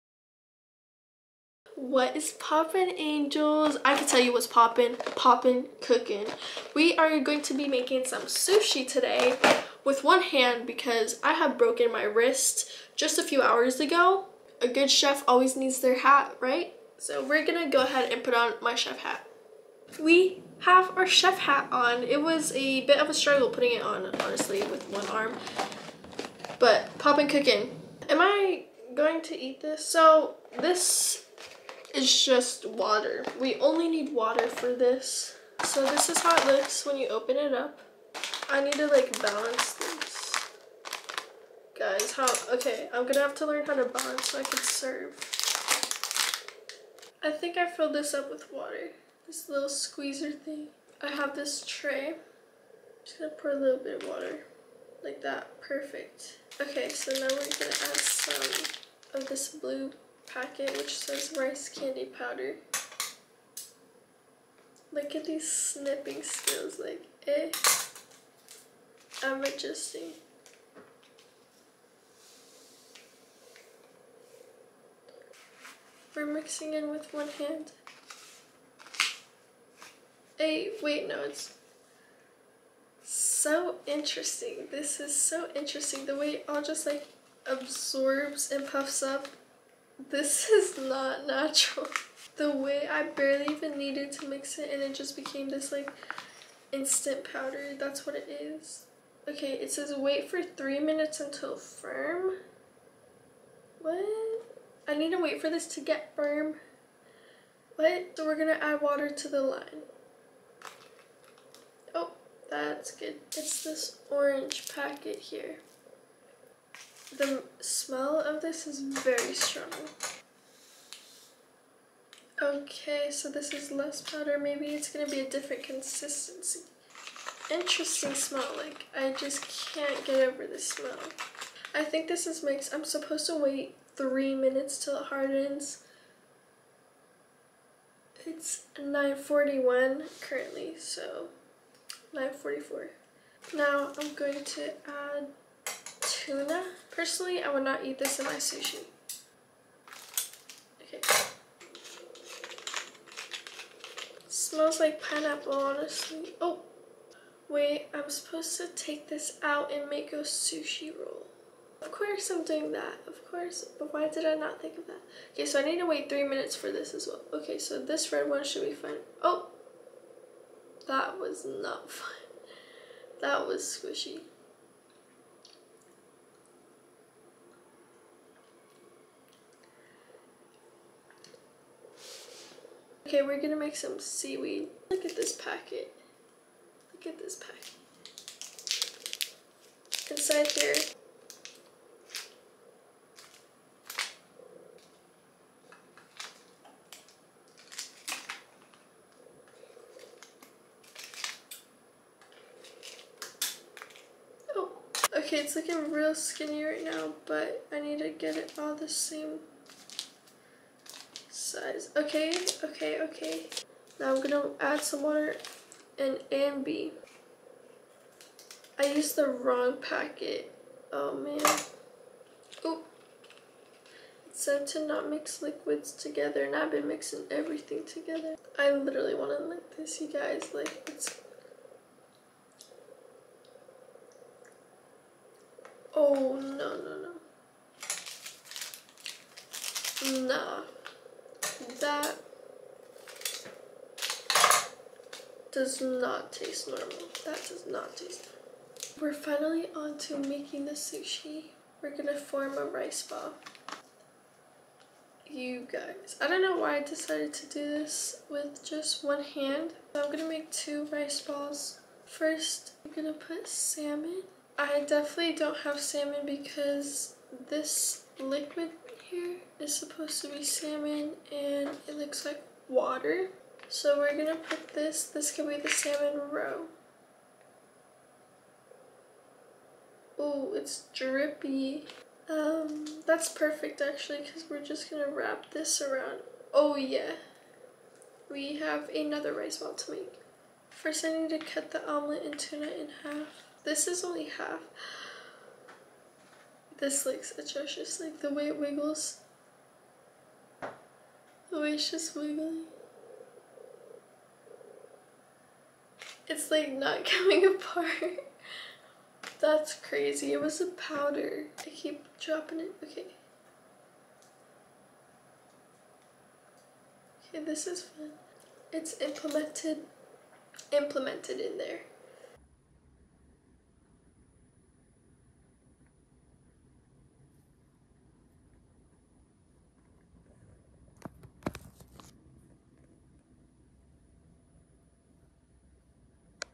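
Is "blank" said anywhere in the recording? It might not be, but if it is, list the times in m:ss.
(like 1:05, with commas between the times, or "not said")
not said.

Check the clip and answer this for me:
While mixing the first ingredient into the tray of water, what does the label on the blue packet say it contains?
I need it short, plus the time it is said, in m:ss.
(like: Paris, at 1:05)
rice candy powder, at 1:01.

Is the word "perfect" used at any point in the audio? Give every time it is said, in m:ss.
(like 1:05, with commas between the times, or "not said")
0:55, 4:43.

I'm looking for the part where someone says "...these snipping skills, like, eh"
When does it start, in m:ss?
1:05.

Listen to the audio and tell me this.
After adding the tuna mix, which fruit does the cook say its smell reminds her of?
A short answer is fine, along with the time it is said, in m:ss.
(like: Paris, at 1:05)
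pineapple, at 2:35.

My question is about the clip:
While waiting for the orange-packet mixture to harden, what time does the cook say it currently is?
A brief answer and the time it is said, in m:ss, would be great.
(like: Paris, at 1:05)
9:41, at 2:18.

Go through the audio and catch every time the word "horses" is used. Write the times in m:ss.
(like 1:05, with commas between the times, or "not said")
not said.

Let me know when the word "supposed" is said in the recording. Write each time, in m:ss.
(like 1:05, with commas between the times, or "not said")
2:12, 2:38, 4:29.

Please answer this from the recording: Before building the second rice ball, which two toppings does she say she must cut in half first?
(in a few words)
omelet and tuna.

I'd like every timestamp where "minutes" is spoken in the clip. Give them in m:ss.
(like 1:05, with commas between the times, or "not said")
1:40, 2:14, 2:46.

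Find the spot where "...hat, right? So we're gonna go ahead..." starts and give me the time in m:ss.
0:15.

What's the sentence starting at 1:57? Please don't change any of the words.
The smell of this is very strong.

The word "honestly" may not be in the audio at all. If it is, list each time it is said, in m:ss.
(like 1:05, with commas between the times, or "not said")
0:24, 2:35.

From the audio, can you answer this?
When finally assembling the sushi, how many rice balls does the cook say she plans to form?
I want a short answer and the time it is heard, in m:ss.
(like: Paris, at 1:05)
2, at 4:20.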